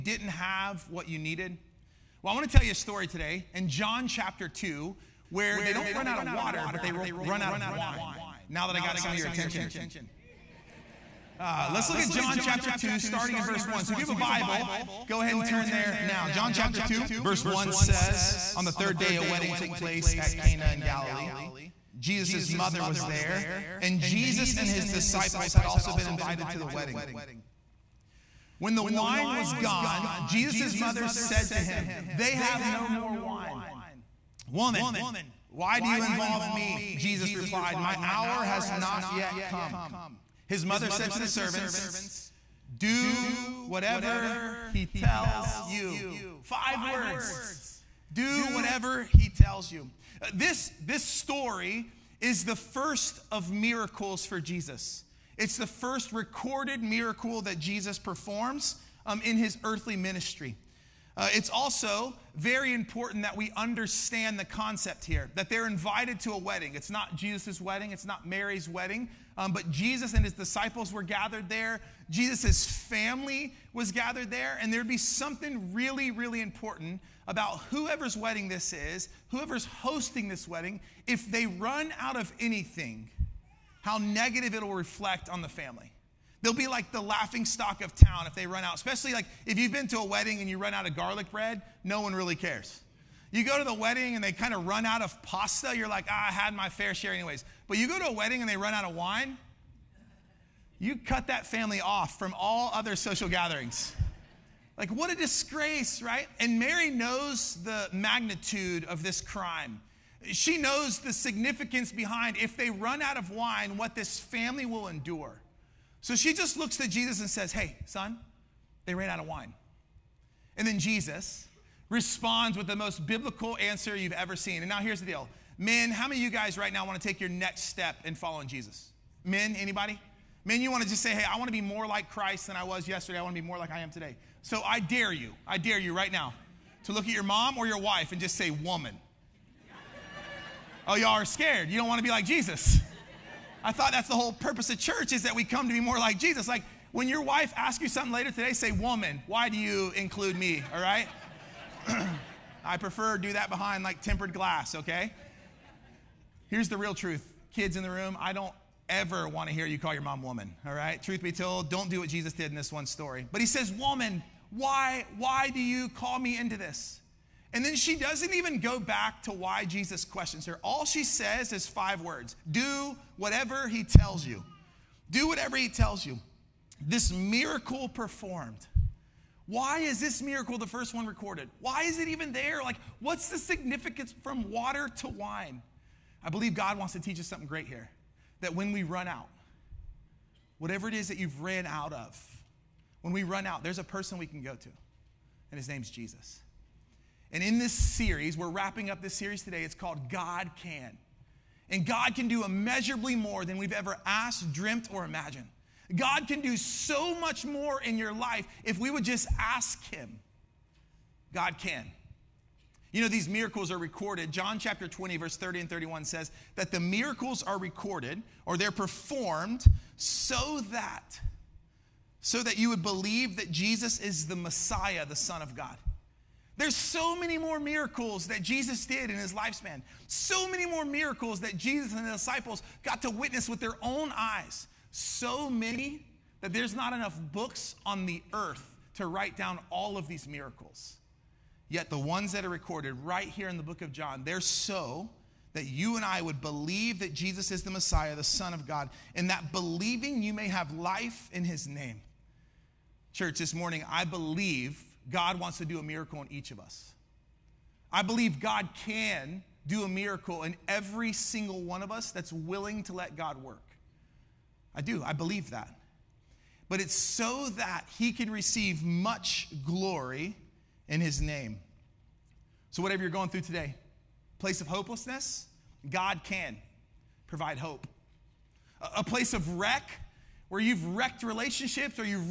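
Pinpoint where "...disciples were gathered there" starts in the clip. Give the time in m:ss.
1:10.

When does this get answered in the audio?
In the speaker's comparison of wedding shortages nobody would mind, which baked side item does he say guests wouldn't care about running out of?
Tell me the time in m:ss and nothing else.
1:30.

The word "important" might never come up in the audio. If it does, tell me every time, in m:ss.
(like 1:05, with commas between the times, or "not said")
1:02, 1:16.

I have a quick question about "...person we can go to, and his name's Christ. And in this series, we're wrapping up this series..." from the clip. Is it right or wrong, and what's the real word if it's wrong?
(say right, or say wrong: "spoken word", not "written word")
wrong: "Jesus", not "Christ".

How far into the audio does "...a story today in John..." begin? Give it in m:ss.
0:02.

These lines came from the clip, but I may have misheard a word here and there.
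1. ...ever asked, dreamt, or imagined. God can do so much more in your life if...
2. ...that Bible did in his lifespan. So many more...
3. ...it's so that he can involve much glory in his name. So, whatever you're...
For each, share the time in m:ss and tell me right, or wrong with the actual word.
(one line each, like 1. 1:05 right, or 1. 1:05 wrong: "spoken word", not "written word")
1. 3:23 right
2. 3:48 wrong: "Jesus", not "Bible"
3. 4:26 wrong: "receive", not "involve".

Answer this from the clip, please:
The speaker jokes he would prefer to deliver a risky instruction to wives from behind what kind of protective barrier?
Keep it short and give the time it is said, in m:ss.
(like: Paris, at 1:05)
tempered glass, at 2:34.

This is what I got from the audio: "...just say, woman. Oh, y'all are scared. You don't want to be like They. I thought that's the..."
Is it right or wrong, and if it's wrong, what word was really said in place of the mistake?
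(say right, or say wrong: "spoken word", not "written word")
wrong: "Jesus", not "They".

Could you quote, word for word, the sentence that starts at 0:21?
Jesus' mother was there, and Jesus and his disciples had also been invited to the wedding.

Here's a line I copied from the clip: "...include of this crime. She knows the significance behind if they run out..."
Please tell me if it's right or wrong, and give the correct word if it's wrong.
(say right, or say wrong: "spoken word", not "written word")
wrong: "magnitude", not "include".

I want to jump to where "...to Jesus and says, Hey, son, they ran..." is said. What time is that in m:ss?
1:56.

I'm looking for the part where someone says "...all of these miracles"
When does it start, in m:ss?
3:59.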